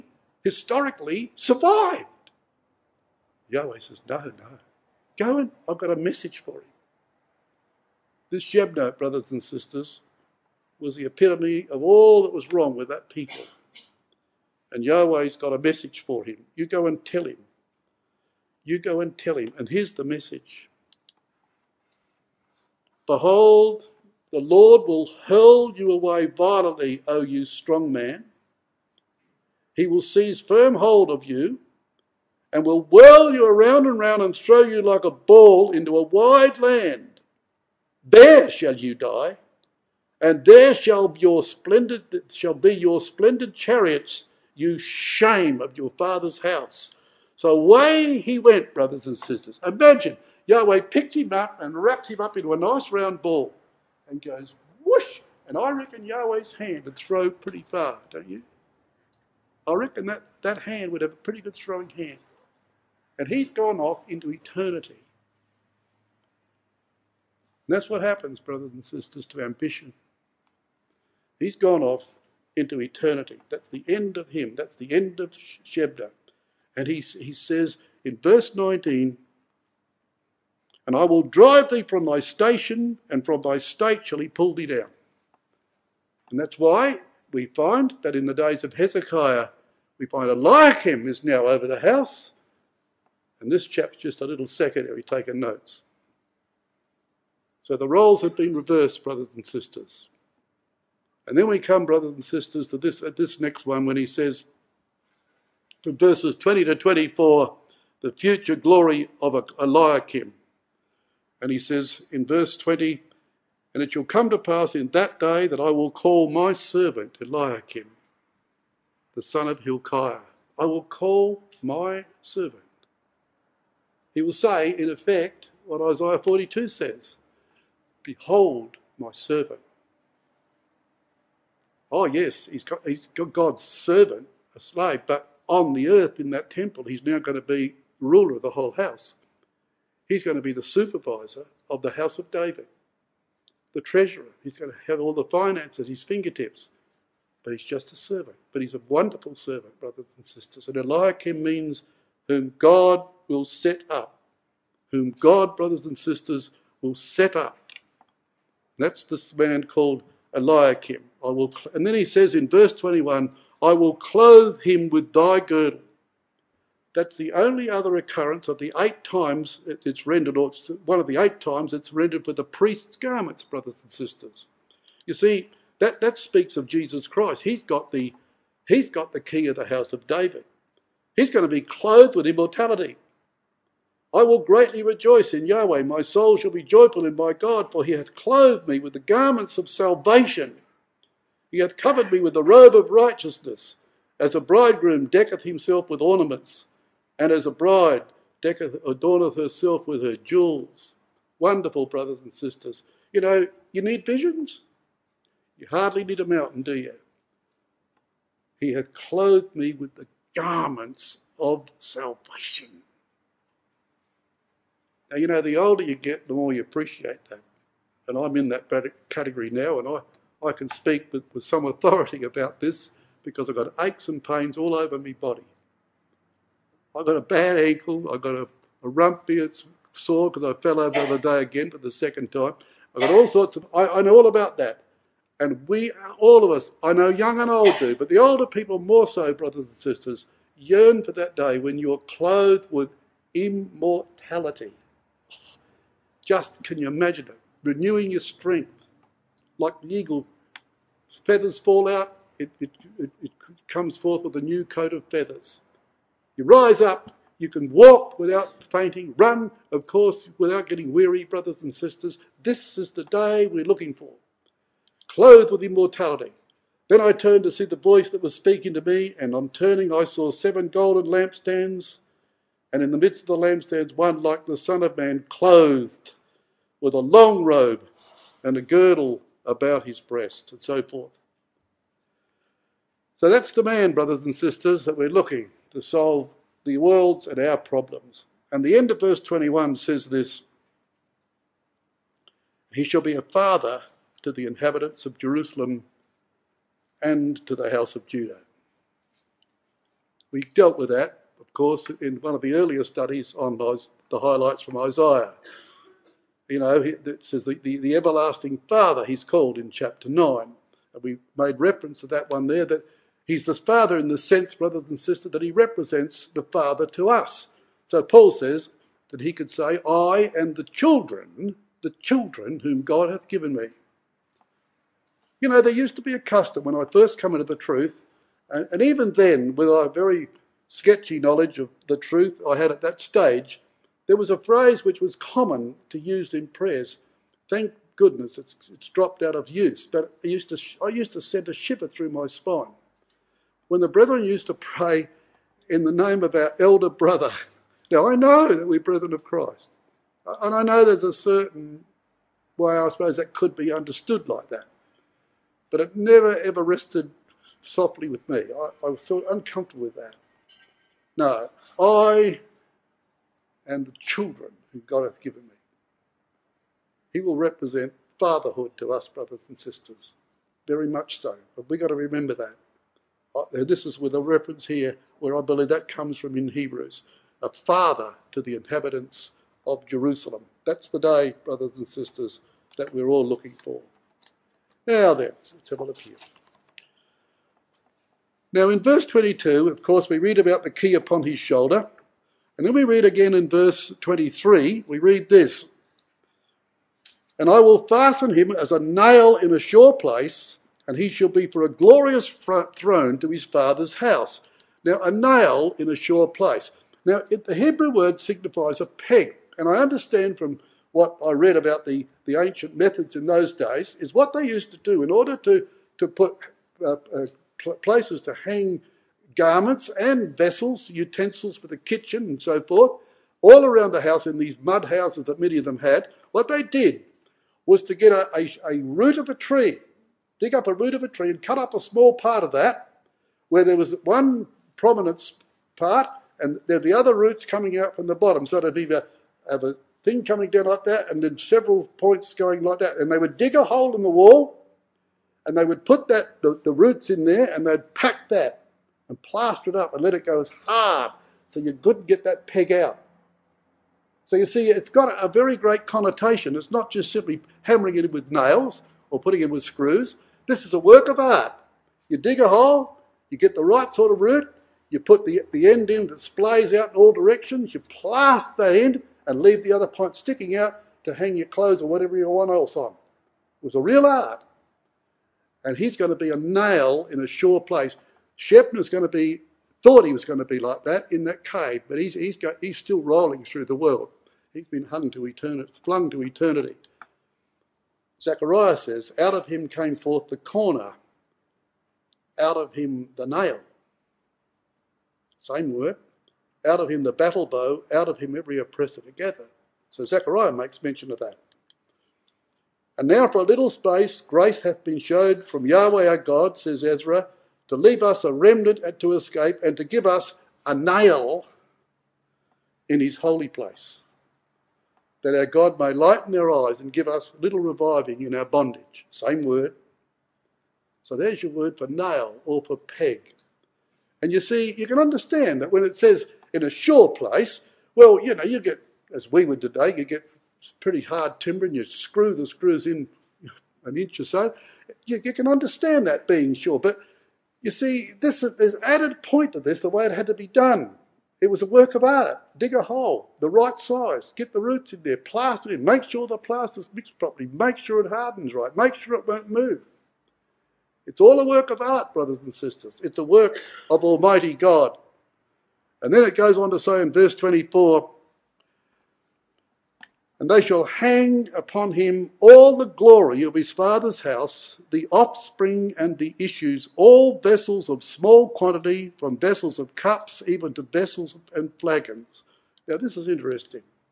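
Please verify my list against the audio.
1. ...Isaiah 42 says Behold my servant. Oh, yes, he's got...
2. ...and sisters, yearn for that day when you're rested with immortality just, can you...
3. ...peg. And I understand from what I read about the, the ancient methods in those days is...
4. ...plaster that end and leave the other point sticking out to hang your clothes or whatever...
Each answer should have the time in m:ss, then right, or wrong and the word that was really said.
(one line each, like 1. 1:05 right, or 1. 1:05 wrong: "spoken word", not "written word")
1. 2:05 right
2. 3:59 wrong: "clothed", not "rested"
3. 6:48 right
4. 7:47 right.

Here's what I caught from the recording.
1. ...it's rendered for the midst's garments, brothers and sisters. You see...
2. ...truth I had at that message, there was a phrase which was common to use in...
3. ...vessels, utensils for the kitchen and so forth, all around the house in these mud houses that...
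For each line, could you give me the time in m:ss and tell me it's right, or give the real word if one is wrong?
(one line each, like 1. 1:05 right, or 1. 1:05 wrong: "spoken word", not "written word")
1. 2:51 wrong: "priest", not "midst"
2. 5:31 wrong: "stage", not "message"
3. 7:00 right.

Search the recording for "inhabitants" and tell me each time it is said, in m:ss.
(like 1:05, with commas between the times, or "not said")
4:54, 6:18.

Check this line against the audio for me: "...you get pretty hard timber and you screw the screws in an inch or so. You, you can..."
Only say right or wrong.
right.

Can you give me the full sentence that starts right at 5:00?
We dealt with that, of course, in one of the earlier studies on the highlights from Isaiah.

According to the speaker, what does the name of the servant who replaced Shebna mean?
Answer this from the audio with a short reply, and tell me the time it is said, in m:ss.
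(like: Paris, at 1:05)
Whom God will set up, at 2:32.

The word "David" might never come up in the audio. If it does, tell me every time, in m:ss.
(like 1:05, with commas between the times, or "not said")
2:22, 3:00.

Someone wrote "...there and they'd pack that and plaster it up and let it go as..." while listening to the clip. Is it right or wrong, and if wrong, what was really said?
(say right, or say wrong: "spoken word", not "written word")
right.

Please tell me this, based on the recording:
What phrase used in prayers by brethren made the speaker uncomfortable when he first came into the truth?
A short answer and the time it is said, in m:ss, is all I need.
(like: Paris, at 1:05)
Our elder brother, at 5:46.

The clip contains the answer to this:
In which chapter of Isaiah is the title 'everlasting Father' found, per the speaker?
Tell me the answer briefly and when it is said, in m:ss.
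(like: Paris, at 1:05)
Chapter 9, at 5:09.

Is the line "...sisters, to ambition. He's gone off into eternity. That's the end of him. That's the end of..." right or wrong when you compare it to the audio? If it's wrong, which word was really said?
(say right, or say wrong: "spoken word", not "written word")
right.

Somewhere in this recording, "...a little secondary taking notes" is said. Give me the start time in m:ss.
1:34.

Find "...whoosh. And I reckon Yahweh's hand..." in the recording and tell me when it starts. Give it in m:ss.
0:54.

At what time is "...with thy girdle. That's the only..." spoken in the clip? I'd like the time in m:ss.
2:44.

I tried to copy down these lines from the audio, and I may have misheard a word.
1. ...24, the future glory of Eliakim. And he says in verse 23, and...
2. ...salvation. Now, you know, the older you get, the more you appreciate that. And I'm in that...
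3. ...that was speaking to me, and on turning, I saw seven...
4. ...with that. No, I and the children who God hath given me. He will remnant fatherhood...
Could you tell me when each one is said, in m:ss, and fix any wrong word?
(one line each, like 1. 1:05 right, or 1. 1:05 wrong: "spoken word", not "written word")
1. 1:46 wrong: "20", not "23"
2. 3:31 right
3. 4:28 right
4. 5:59 wrong: "represent", not "remnant".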